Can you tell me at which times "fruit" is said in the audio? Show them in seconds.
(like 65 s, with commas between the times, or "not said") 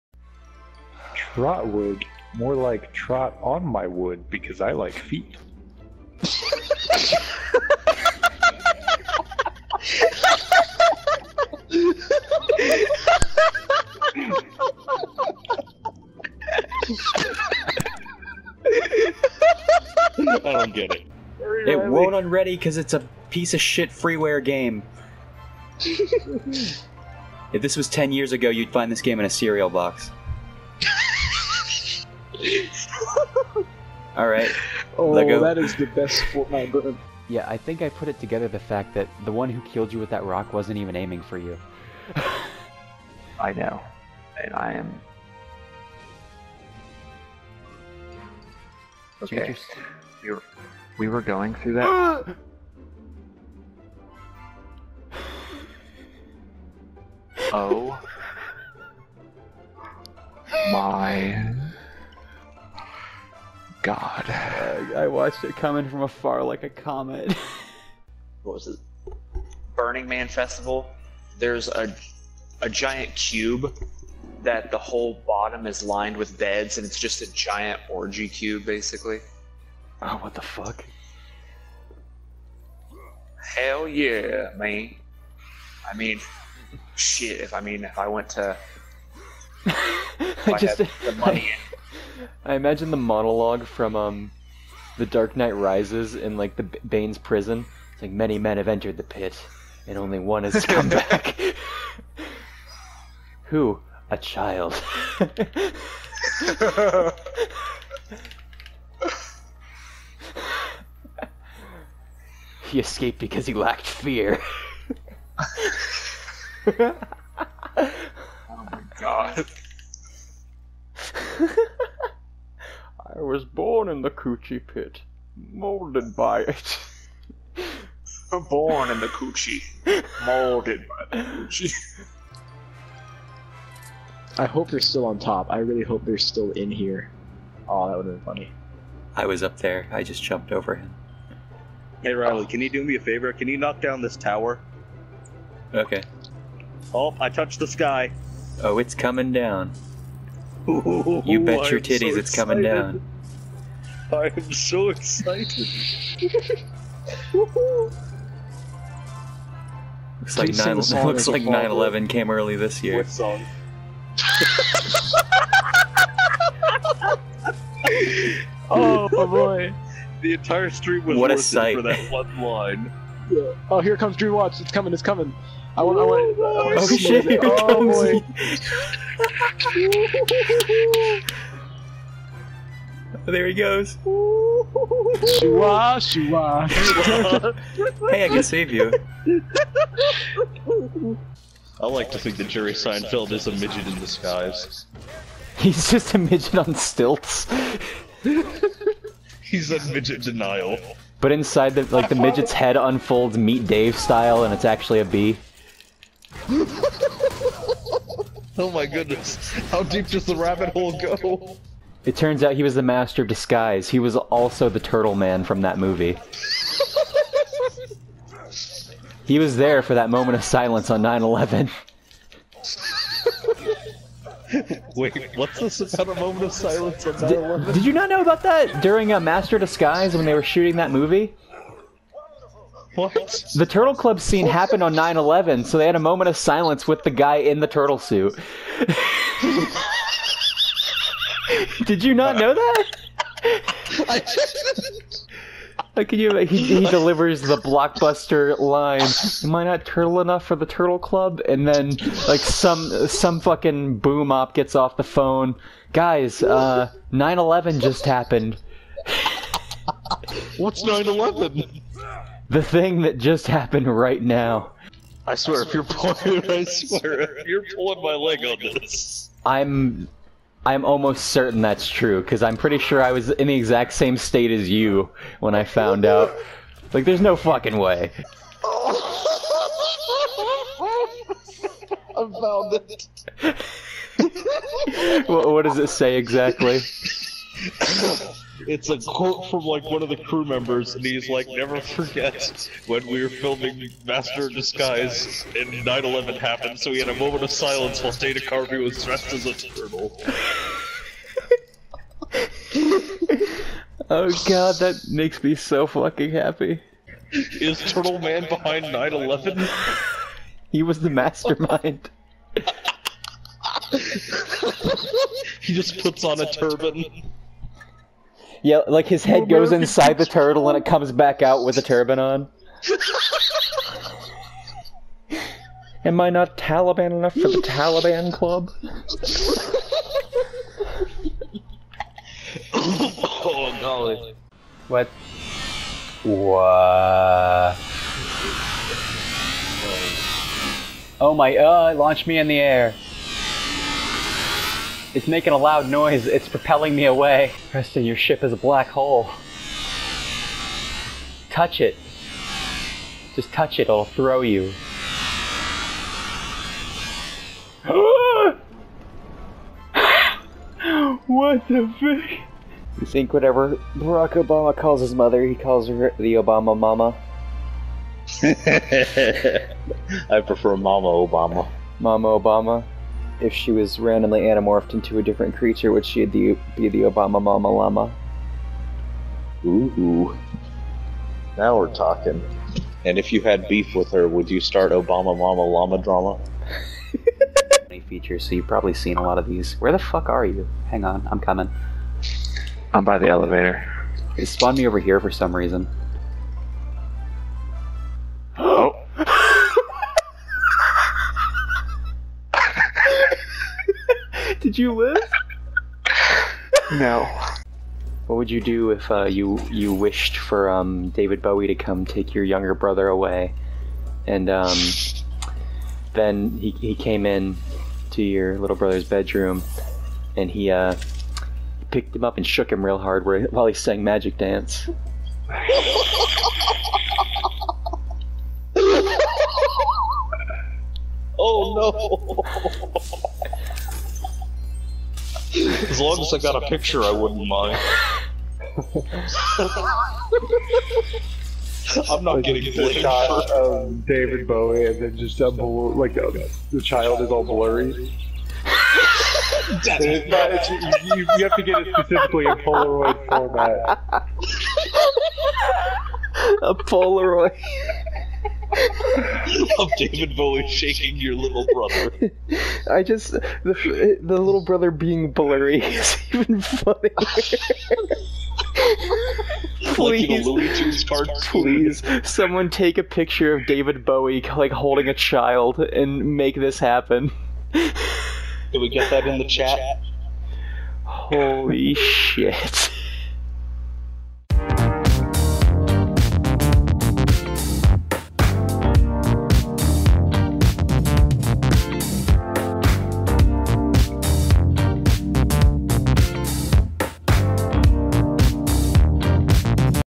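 not said.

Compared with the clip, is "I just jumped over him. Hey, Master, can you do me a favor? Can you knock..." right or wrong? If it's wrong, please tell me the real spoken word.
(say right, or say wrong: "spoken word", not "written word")
wrong: "Riley", not "Master".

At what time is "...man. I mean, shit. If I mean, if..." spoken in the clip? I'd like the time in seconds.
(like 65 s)
84 s.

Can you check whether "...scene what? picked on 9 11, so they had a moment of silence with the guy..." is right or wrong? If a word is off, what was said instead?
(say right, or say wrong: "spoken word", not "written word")
wrong: "happened", not "picked".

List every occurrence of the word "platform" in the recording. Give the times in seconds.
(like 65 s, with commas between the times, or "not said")
not said.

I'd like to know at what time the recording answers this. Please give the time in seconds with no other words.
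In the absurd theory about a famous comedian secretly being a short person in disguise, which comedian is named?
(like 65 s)
192 s.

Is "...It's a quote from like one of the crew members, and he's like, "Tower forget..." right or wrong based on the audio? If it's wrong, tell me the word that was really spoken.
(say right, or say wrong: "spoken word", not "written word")
wrong: "Never", not "Tower".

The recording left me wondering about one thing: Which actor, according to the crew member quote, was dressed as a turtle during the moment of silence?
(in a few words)
Dana Carvey.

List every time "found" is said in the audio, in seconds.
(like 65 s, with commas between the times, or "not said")
275 s, 282 s.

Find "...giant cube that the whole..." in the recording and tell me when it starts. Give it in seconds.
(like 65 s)
72 s.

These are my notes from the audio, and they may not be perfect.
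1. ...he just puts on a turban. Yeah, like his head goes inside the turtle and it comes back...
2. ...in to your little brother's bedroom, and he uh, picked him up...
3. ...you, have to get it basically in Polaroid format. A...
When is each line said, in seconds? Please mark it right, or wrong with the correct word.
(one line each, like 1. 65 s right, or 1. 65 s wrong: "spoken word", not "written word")
1. 315 s right
2. 417 s right
3. 451 s wrong: "specifically", not "basically".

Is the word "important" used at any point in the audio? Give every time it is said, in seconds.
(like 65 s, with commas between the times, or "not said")
not said.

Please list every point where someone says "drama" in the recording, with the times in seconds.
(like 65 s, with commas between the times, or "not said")
385 s.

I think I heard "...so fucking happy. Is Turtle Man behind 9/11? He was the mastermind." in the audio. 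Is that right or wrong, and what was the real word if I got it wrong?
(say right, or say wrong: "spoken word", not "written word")
right.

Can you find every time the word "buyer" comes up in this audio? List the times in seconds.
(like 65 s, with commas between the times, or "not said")
not said.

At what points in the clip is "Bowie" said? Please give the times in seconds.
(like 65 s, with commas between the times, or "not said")
411 s, 444 s, 460 s, 474 s.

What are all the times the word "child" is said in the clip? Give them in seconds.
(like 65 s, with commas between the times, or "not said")
104 s, 446 s, 475 s.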